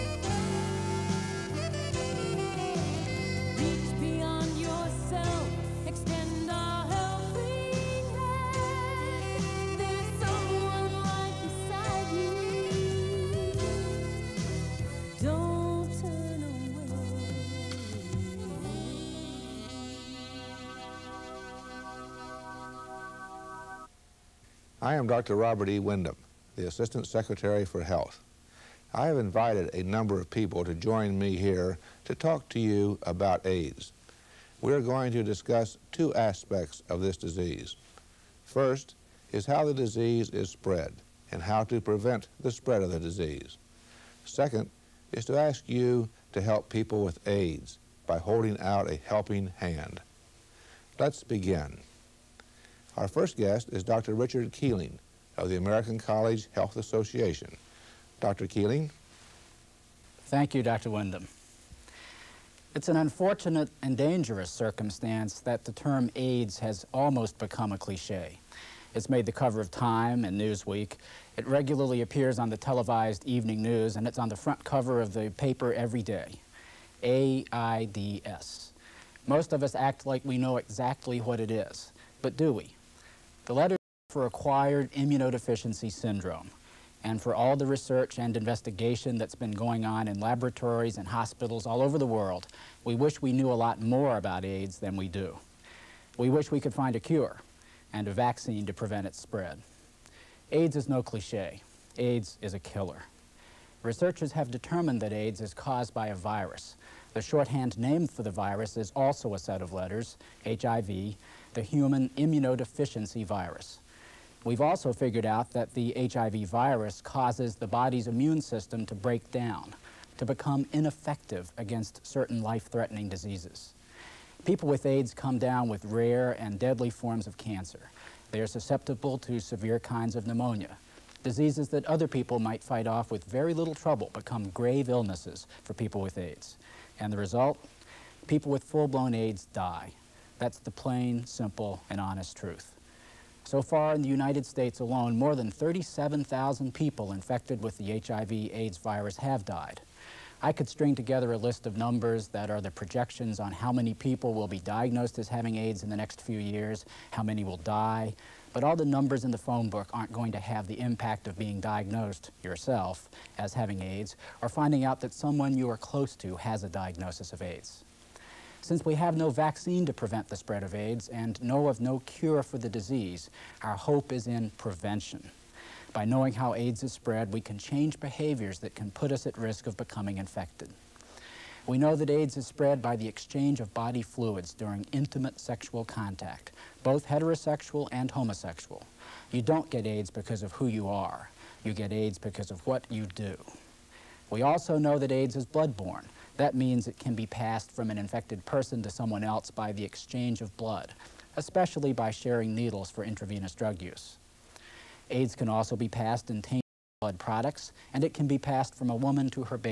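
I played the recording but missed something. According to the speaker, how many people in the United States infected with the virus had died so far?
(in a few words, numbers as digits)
more than 37,000.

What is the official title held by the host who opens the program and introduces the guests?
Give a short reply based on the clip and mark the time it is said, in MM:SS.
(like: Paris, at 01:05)
Assistant Secretary for Health, at 00:26.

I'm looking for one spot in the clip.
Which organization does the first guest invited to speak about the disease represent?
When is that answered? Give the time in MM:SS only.
00:55.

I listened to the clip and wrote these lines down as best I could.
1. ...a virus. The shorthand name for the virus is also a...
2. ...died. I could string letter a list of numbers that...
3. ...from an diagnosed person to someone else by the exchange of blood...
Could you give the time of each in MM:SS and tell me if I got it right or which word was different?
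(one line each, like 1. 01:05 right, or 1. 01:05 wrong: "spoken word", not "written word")
1. 01:46 right
2. 02:29 wrong: "together", not "letter"
3. 03:17 wrong: "infected", not "diagnosed".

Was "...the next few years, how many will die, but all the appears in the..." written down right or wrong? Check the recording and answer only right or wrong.
wrong.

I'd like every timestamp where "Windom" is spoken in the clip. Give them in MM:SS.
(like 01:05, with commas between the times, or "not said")
00:25, 01:00.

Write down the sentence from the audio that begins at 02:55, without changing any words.
By knowing how AIDS is spread, we can change behaviors that can put us at risk of becoming infected.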